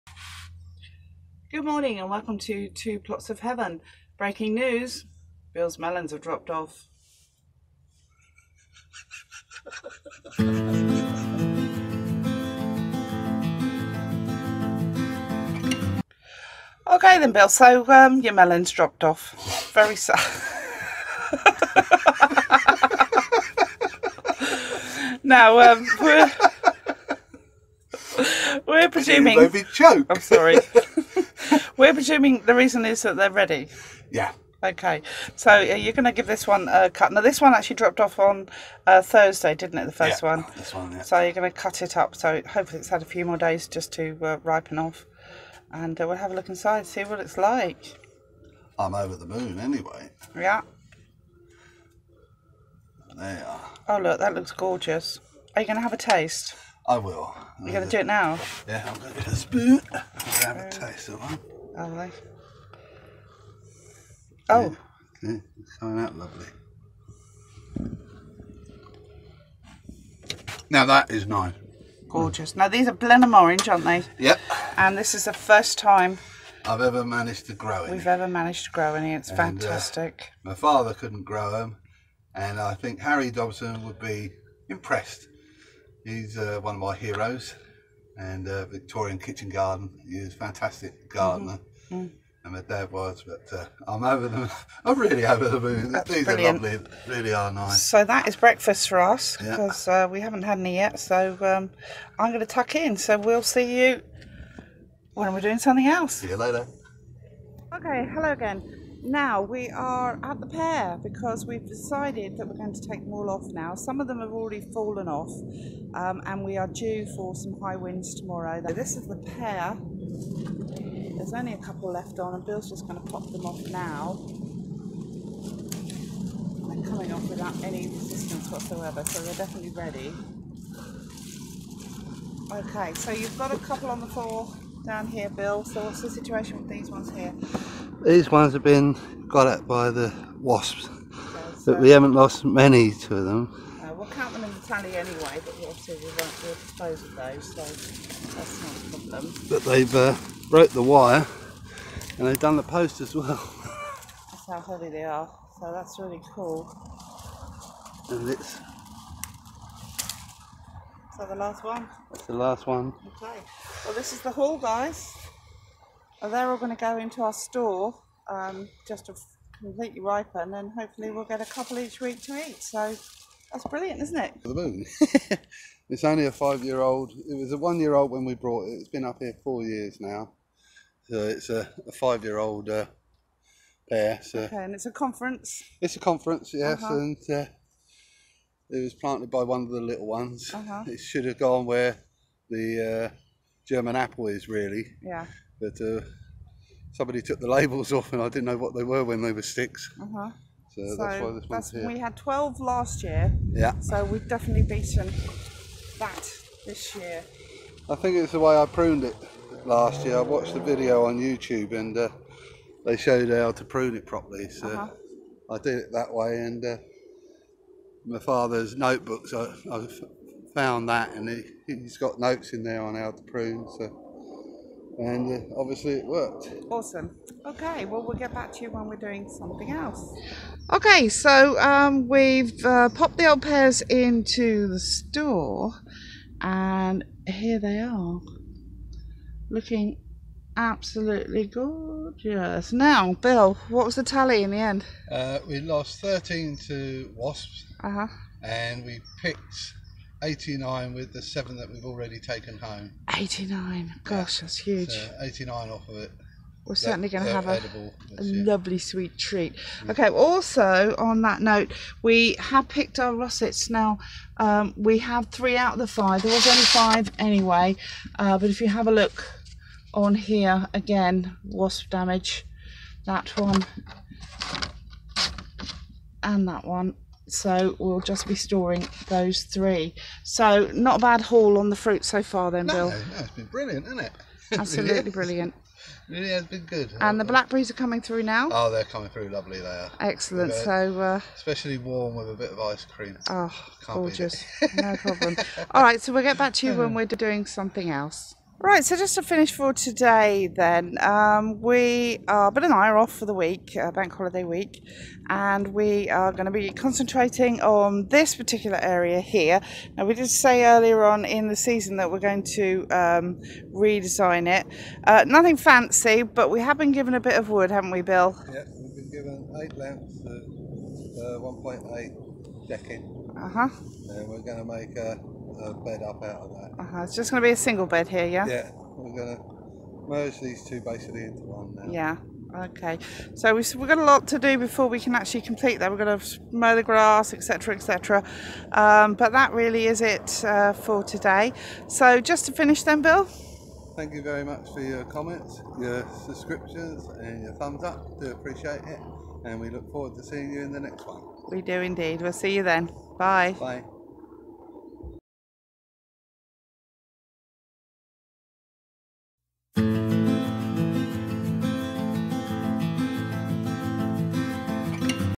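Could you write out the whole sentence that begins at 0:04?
Breaking news, Bill's melons have dropped off.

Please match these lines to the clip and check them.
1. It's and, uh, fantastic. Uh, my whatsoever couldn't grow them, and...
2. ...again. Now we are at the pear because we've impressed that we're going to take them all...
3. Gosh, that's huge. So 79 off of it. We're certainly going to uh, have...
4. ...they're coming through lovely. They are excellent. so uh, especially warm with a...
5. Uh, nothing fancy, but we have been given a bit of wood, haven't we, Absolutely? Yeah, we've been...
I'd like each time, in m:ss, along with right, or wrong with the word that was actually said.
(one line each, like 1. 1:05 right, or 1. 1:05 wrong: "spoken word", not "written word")
1. 1:19 wrong: "father", not "whatsoever"
2. 1:48 wrong: "decided", not "impressed"
3. 4:14 wrong: "89", not "79"
4. 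4:48 right
5. 5:15 wrong: "Bill", not "Absolutely".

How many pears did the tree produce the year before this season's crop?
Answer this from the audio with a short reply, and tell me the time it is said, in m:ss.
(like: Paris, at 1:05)
12, at 3:22.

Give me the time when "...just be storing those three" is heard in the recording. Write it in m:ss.
4:38.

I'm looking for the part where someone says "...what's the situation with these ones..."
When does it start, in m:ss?
2:15.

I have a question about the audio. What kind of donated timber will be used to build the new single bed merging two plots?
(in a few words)
decking.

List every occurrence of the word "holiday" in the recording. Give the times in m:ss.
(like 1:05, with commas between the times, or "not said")
5:04.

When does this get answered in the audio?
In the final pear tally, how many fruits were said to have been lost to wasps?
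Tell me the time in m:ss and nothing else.
4:06.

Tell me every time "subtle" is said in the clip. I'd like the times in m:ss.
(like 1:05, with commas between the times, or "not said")
not said.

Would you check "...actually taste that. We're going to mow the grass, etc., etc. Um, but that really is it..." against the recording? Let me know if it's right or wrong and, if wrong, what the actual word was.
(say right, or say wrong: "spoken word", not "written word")
wrong: "complete", not "taste".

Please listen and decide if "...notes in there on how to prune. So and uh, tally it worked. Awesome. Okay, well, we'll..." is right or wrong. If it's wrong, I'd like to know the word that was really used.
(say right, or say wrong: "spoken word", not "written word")
wrong: "obviously", not "tally".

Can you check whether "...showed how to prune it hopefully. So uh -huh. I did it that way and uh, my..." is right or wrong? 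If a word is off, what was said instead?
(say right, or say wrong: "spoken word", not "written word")
wrong: "properly", not "hopefully".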